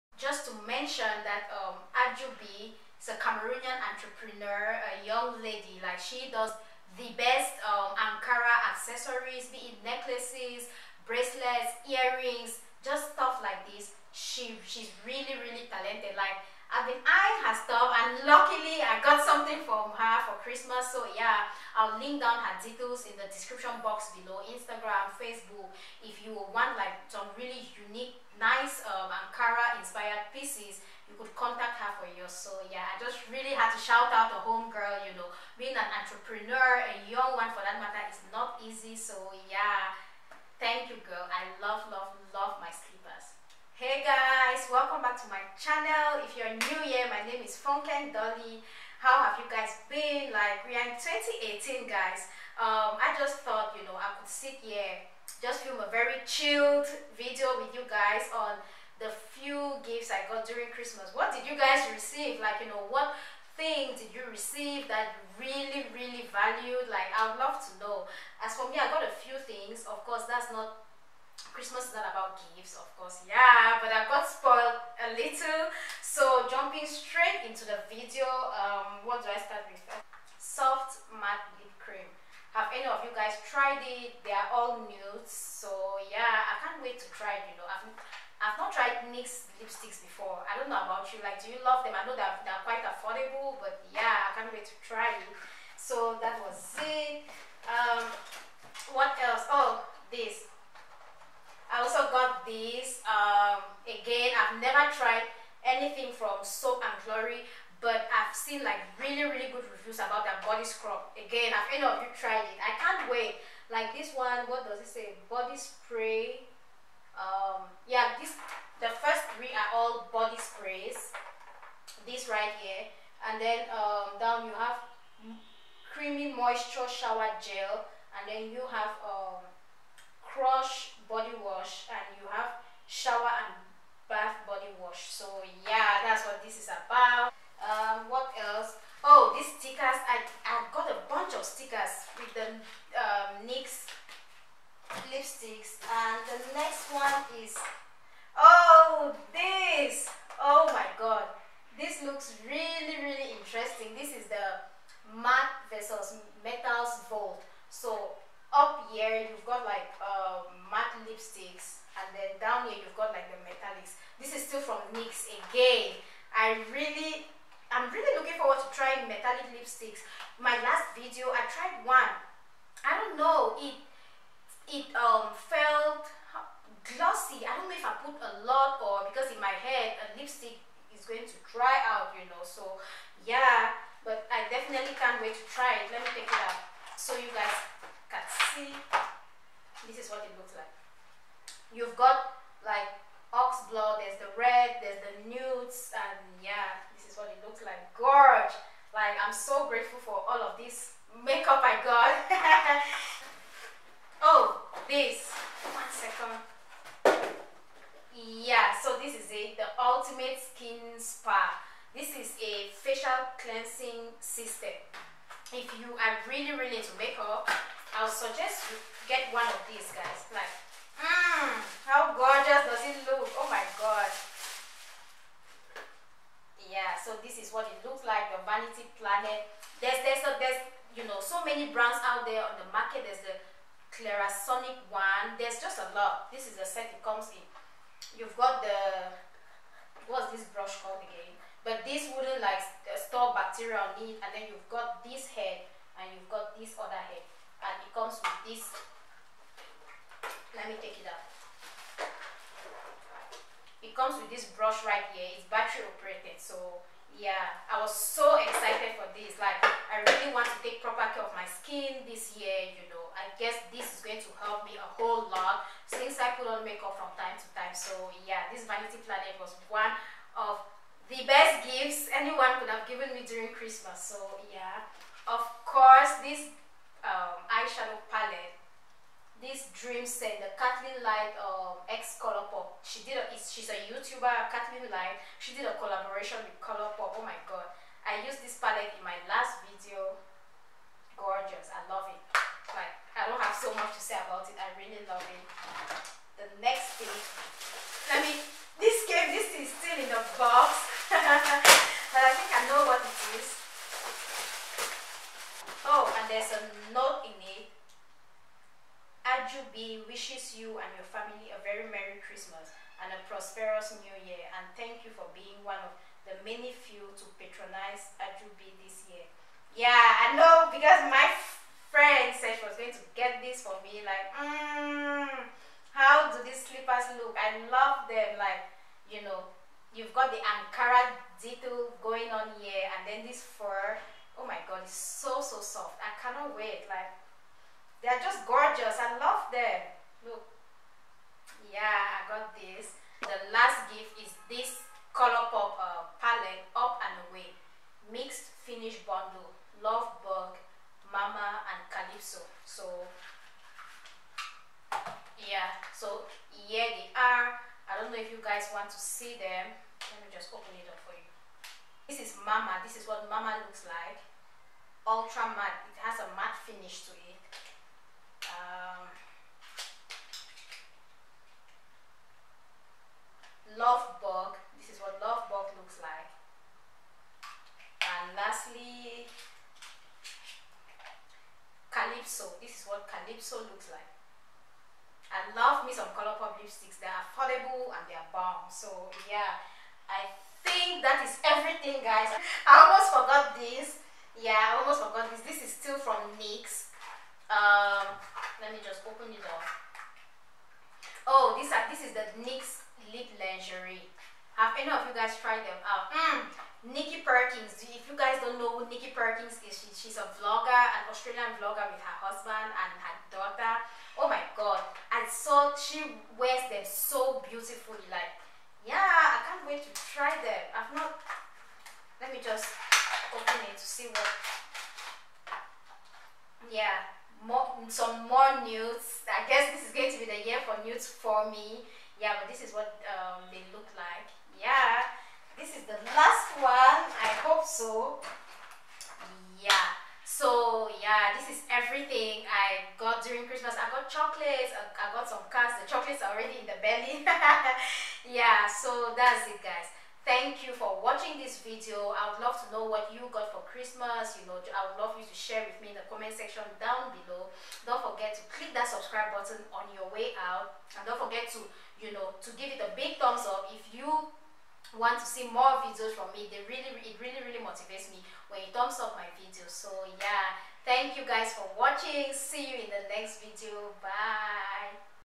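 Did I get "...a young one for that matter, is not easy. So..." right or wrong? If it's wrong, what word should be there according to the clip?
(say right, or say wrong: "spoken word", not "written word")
right.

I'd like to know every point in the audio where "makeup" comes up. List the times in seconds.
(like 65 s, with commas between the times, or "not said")
216 s, 266 s.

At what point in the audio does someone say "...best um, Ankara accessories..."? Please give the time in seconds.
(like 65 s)
7 s.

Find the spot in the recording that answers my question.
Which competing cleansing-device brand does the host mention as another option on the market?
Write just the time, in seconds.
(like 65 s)
233 s.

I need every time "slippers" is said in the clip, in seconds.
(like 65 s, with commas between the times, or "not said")
42 s, 326 s.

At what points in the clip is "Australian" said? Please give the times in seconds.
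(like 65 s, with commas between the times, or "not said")
411 s.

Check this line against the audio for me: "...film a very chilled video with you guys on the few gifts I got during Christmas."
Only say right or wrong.
right.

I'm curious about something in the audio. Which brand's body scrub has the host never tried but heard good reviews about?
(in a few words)
Soap and Glory.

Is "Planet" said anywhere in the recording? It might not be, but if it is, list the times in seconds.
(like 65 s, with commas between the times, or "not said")
228 s, 269 s.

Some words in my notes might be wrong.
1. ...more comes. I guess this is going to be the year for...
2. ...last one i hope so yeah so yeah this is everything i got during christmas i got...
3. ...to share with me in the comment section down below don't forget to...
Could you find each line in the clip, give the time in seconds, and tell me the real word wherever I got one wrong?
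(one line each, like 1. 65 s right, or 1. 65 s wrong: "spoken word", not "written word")
1. 428 s wrong: "nudes", not "comes"
2. 436 s right
3. 455 s right.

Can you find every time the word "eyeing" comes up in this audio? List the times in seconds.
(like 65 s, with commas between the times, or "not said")
17 s.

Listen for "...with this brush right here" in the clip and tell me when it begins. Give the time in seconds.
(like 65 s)
254 s.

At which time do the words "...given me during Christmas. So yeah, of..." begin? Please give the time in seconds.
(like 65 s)
272 s.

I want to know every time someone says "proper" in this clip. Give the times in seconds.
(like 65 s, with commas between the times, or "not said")
260 s.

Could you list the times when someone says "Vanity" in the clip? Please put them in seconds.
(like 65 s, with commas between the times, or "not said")
228 s, 268 s.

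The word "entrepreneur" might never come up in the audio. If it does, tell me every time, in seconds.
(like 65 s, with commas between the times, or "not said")
3 s, 35 s.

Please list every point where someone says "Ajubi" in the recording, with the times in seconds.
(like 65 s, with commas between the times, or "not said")
1 s, 309 s, 318 s.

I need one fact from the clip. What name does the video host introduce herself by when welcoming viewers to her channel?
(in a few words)
Fonkeng Dolly.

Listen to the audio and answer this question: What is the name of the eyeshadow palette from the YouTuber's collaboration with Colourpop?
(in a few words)
Dream Set.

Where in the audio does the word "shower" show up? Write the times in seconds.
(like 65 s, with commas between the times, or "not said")
126 s, 132 s.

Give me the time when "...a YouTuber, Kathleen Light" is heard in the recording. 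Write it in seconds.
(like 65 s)
283 s.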